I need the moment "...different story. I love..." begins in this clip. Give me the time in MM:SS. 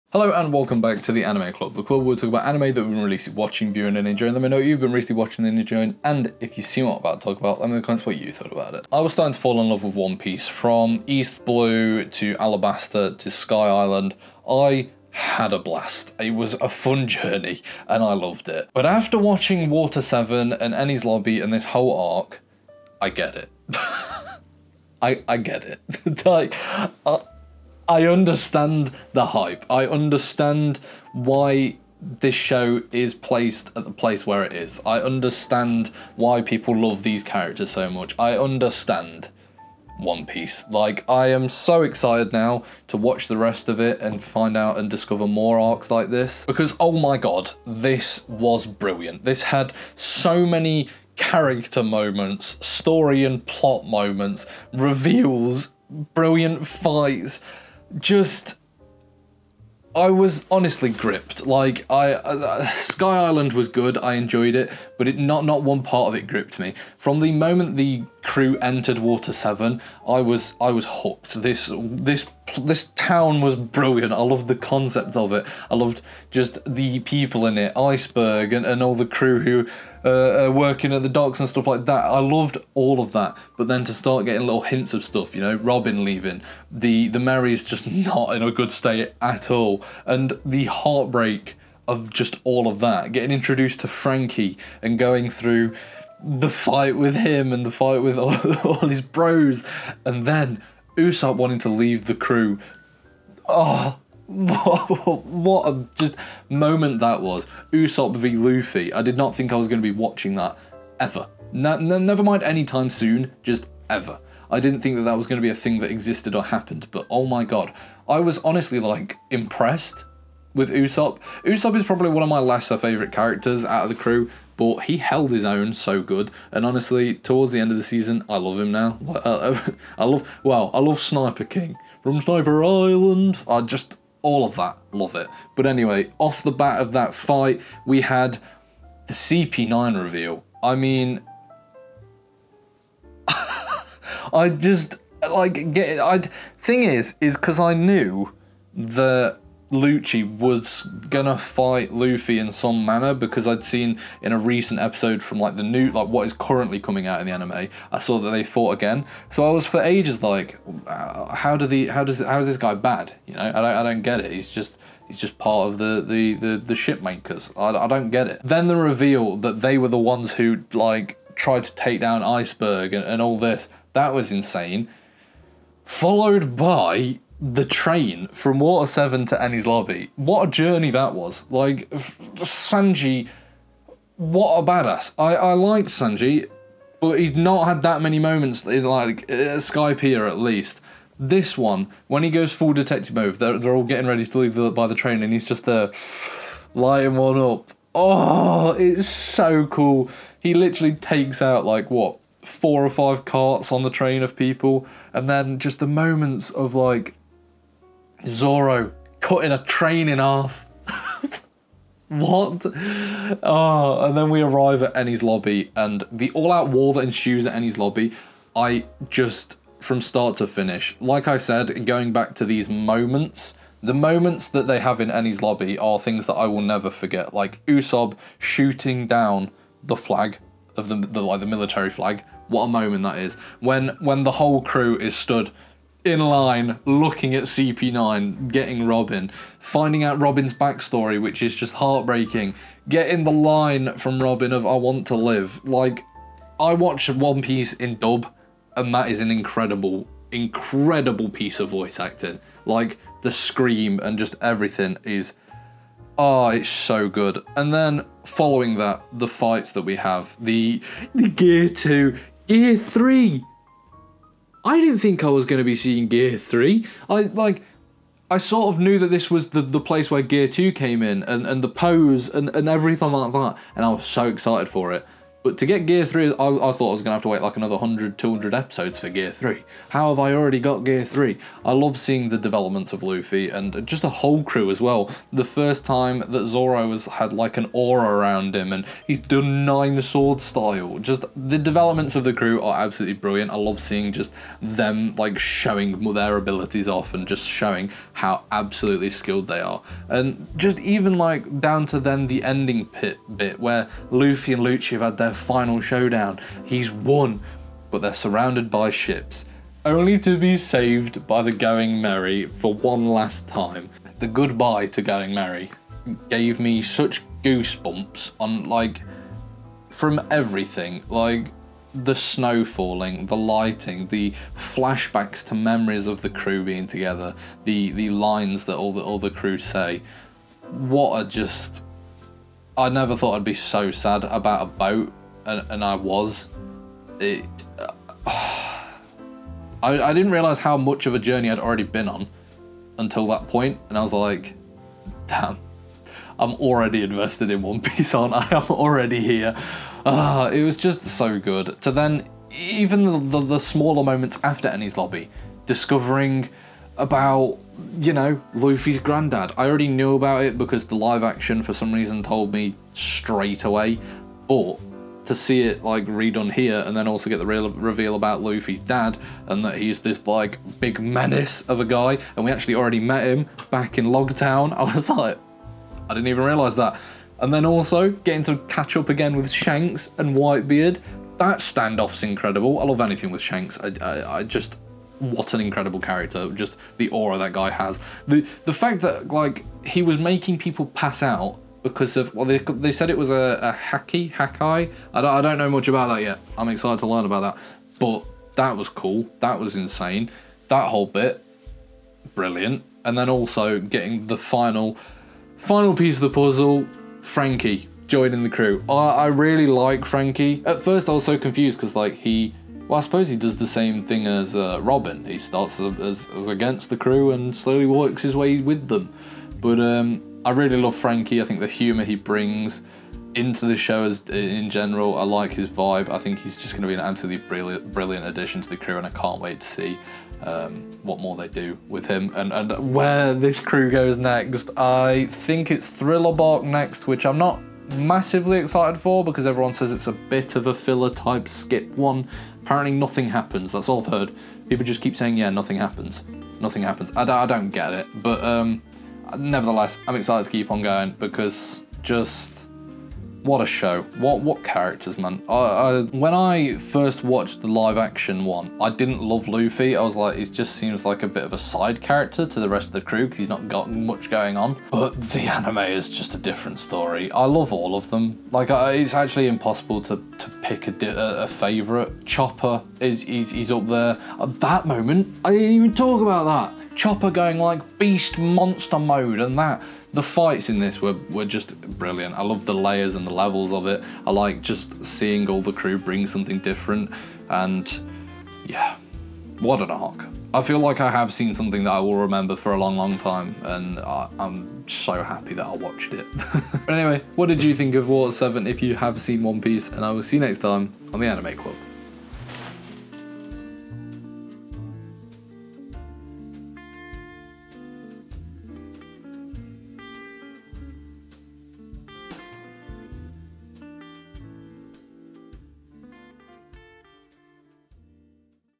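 07:46.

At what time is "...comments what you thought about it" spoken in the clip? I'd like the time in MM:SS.
00:07.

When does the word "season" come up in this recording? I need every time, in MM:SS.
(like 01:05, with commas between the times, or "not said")
02:07.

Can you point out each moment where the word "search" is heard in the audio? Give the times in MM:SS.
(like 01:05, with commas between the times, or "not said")
not said.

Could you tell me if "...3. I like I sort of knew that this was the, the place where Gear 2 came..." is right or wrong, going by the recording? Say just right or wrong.
right.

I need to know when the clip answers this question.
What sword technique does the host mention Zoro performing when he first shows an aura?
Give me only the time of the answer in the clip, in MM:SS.
04:49.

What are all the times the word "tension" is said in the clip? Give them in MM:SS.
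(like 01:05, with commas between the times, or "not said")
not said.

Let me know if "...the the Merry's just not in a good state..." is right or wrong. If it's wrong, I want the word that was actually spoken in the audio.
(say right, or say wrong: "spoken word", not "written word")
right.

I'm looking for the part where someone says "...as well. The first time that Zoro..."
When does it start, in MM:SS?
04:44.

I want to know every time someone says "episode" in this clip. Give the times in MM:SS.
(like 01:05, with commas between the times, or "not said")
02:34, 04:38.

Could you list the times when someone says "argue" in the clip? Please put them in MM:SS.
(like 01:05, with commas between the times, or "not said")
not said.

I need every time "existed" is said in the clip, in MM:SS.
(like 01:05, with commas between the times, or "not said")
01:55.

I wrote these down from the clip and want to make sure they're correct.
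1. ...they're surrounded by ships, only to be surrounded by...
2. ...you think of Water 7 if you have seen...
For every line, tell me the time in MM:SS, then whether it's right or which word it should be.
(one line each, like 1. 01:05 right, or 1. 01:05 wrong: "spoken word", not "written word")
1. 05:08 wrong: "saved", not "surrounded"
2. 08:17 right.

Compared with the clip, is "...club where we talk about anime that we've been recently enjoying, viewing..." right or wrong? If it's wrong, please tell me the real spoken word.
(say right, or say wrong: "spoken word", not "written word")
wrong: "watching", not "enjoying".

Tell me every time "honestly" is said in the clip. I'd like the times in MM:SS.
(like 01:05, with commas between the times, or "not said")
01:00, 01:58, 02:06.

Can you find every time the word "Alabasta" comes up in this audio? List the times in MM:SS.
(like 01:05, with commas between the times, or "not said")
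00:12.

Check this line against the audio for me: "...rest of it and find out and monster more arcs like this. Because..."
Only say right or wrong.
wrong.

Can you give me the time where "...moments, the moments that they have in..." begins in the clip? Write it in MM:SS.
03:42.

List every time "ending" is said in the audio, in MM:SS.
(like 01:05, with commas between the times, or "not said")
05:02.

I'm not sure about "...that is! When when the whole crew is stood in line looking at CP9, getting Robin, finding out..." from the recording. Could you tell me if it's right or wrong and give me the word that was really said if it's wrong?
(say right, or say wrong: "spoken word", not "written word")
right.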